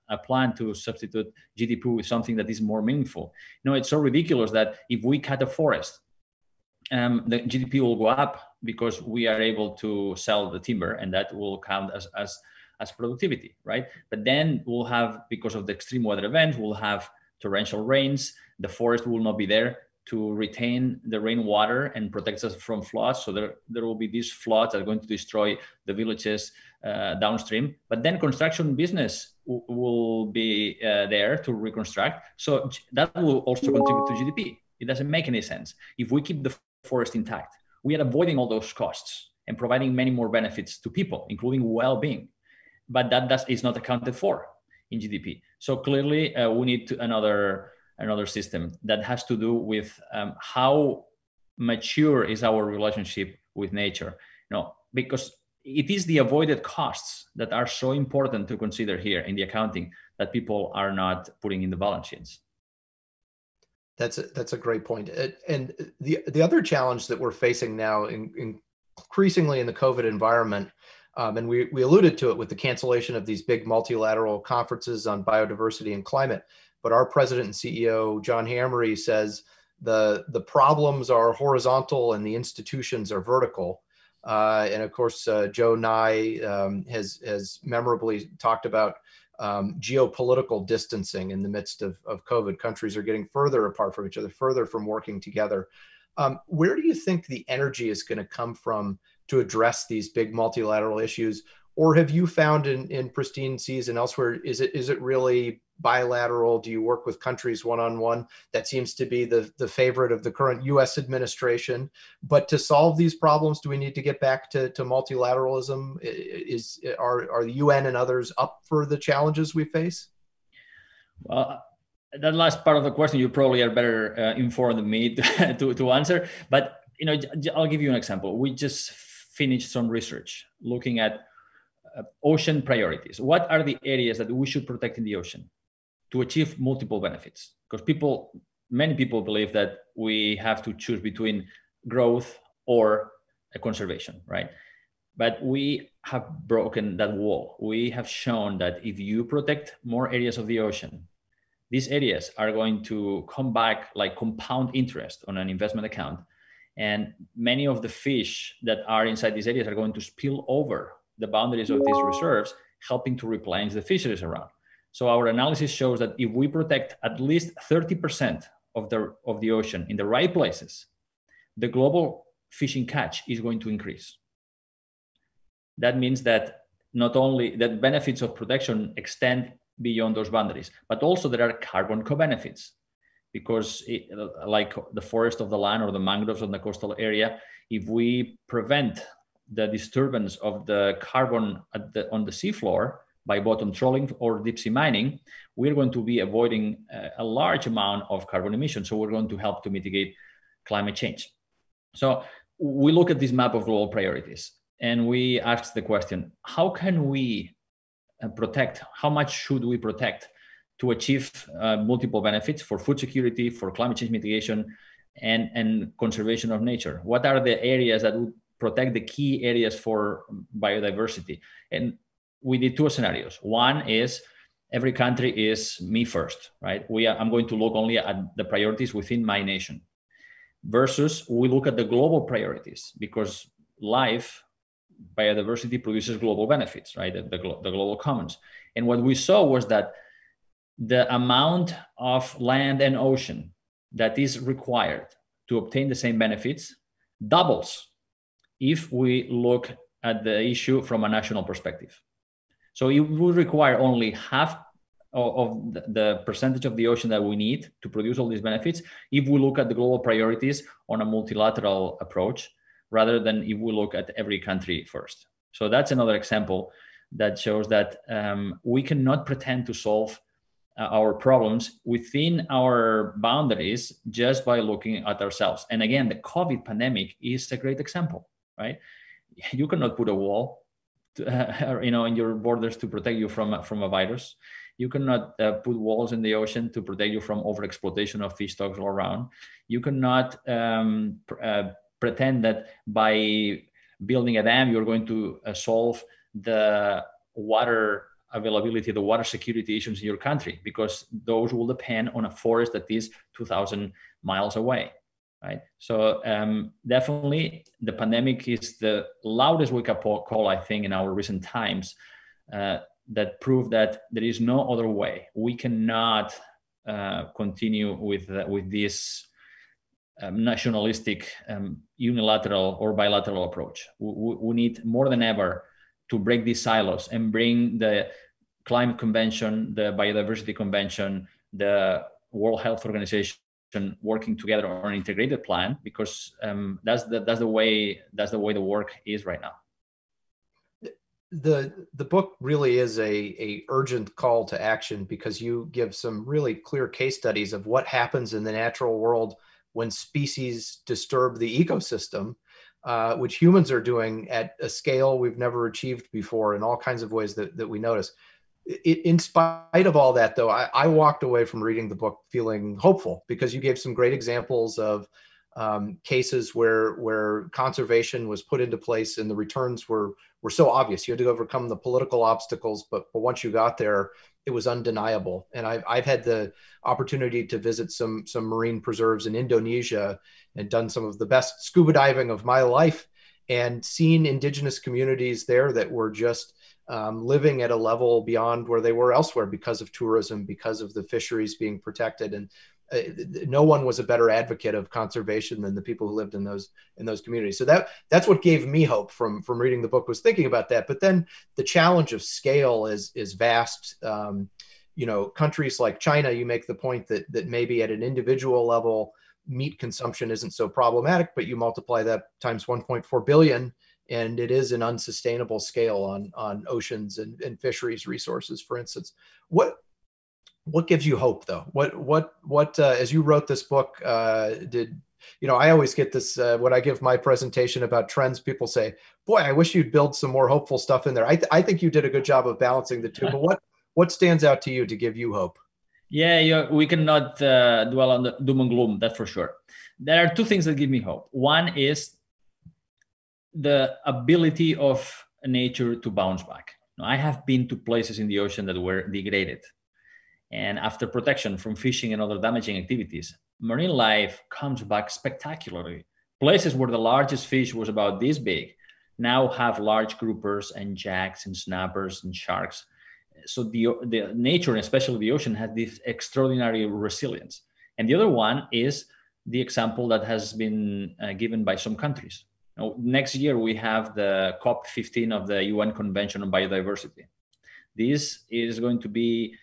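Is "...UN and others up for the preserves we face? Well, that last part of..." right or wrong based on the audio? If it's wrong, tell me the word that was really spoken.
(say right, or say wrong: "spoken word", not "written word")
wrong: "challenges", not "preserves".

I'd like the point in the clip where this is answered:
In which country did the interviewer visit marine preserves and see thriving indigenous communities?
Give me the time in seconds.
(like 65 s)
379 s.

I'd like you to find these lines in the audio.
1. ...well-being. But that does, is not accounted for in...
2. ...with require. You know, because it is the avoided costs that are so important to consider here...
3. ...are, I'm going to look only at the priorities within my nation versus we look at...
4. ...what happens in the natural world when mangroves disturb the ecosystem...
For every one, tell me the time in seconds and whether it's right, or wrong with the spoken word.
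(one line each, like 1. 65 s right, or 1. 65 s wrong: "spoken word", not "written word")
1. 41 s right
2. 53 s wrong: "nature", not "require"
3. 227 s right
4. 347 s wrong: "species", not "mangroves".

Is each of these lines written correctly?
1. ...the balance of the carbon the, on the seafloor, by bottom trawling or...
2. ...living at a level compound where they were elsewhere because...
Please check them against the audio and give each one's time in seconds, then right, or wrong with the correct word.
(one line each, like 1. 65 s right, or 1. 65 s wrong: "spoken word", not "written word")
1. 189 s wrong: "disturbance", not "balance"
2. 387 s wrong: "beyond", not "compound".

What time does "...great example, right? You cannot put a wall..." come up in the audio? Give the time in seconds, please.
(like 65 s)
277 s.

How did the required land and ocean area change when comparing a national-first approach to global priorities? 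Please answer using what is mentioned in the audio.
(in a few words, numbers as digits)
doubles.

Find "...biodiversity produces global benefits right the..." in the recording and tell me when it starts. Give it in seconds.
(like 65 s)
235 s.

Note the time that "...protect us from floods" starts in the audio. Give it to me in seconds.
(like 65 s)
22 s.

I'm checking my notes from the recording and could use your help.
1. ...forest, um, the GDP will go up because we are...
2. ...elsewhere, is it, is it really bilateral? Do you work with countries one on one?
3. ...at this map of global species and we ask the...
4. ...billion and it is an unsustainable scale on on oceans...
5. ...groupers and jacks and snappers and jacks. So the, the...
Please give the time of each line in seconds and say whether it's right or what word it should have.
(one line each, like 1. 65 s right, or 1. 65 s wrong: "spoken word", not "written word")
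1. 5 s right
2. 103 s right
3. 203 s wrong: "priorities", not "species"
4. 413 s right
5. 460 s wrong: "sharks", not "jacks".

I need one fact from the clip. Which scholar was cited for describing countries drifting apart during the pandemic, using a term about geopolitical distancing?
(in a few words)
Joe Nye.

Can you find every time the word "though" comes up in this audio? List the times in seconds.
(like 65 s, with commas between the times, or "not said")
360 s, 421 s.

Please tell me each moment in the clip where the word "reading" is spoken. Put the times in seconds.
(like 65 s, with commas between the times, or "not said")
361 s, 399 s.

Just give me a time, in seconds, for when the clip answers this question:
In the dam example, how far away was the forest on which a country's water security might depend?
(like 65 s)
303 s.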